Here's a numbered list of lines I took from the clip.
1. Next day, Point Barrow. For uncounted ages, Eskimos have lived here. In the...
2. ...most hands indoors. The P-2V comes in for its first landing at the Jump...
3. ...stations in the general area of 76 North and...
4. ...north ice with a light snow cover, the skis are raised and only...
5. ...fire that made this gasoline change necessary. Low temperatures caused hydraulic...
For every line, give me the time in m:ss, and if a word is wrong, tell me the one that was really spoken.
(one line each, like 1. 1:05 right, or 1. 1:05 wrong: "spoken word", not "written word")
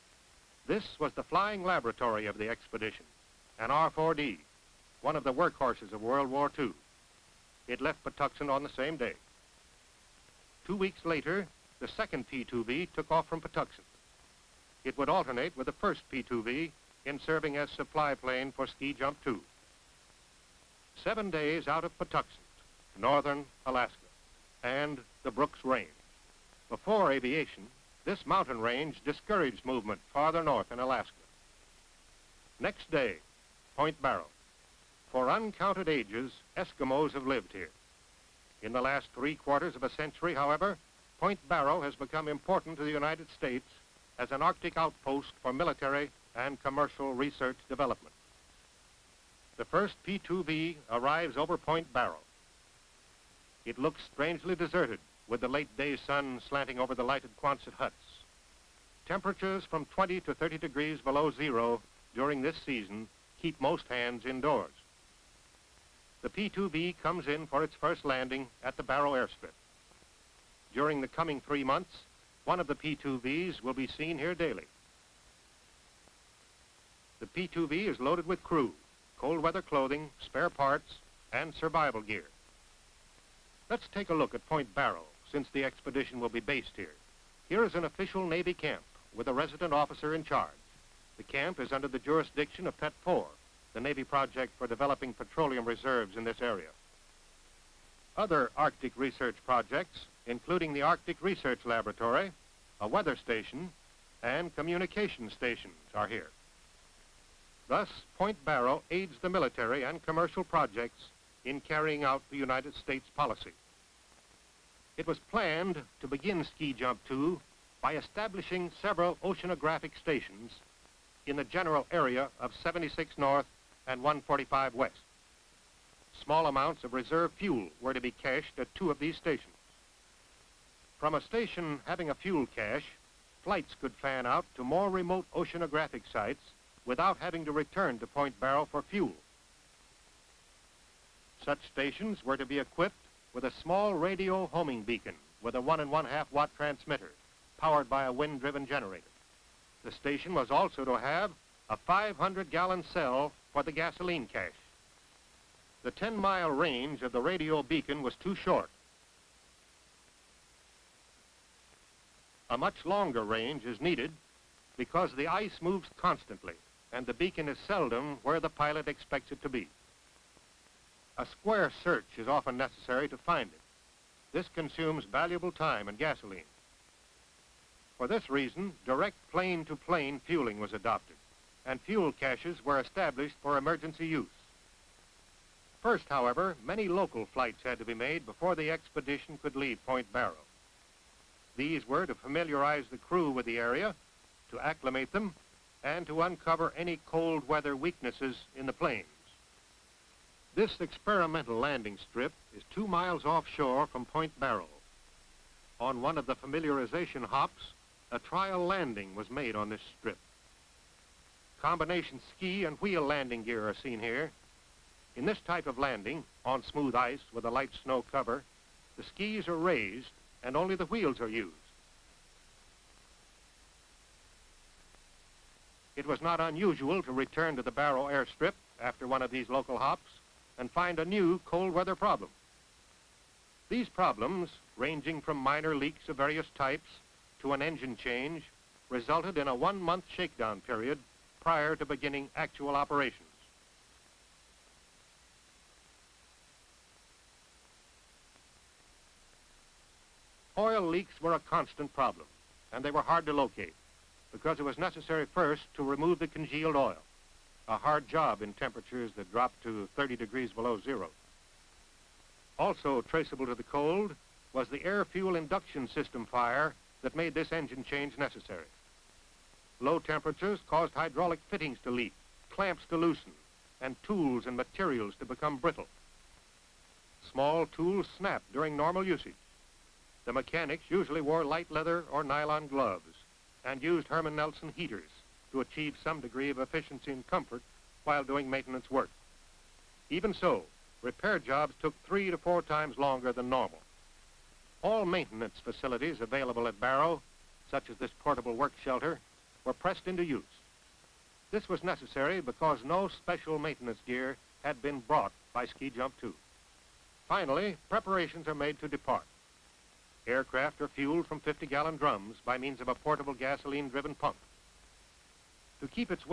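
1. 0:32 right
2. 1:03 wrong: "Barrow", not "Jump"
3. 1:59 right
4. 3:36 wrong: "smooth", not "north"
5. 4:26 wrong: "engine", not "gasoline".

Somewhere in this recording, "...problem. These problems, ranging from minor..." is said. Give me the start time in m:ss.
3:51.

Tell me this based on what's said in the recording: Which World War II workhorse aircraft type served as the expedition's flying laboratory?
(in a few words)
R-4D.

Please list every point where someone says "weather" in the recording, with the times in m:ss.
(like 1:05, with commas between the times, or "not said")
1:19, 1:42, 3:17, 3:51.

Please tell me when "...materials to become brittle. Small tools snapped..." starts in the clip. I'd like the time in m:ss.
4:34.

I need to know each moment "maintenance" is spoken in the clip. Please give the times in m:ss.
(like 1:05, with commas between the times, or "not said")
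4:48, 4:55, 5:03.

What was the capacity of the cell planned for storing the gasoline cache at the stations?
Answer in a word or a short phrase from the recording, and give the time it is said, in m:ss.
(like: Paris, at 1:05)
500 gallons, at 2:31.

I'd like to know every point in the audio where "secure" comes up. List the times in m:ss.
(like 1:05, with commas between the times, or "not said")
not said.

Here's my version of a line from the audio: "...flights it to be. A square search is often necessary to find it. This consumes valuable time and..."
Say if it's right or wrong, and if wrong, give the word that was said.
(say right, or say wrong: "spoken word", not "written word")
wrong: "expects", not "flights".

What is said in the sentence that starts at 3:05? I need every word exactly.
First, however, many local flights had to be made before the expedition could leave Point Barrow.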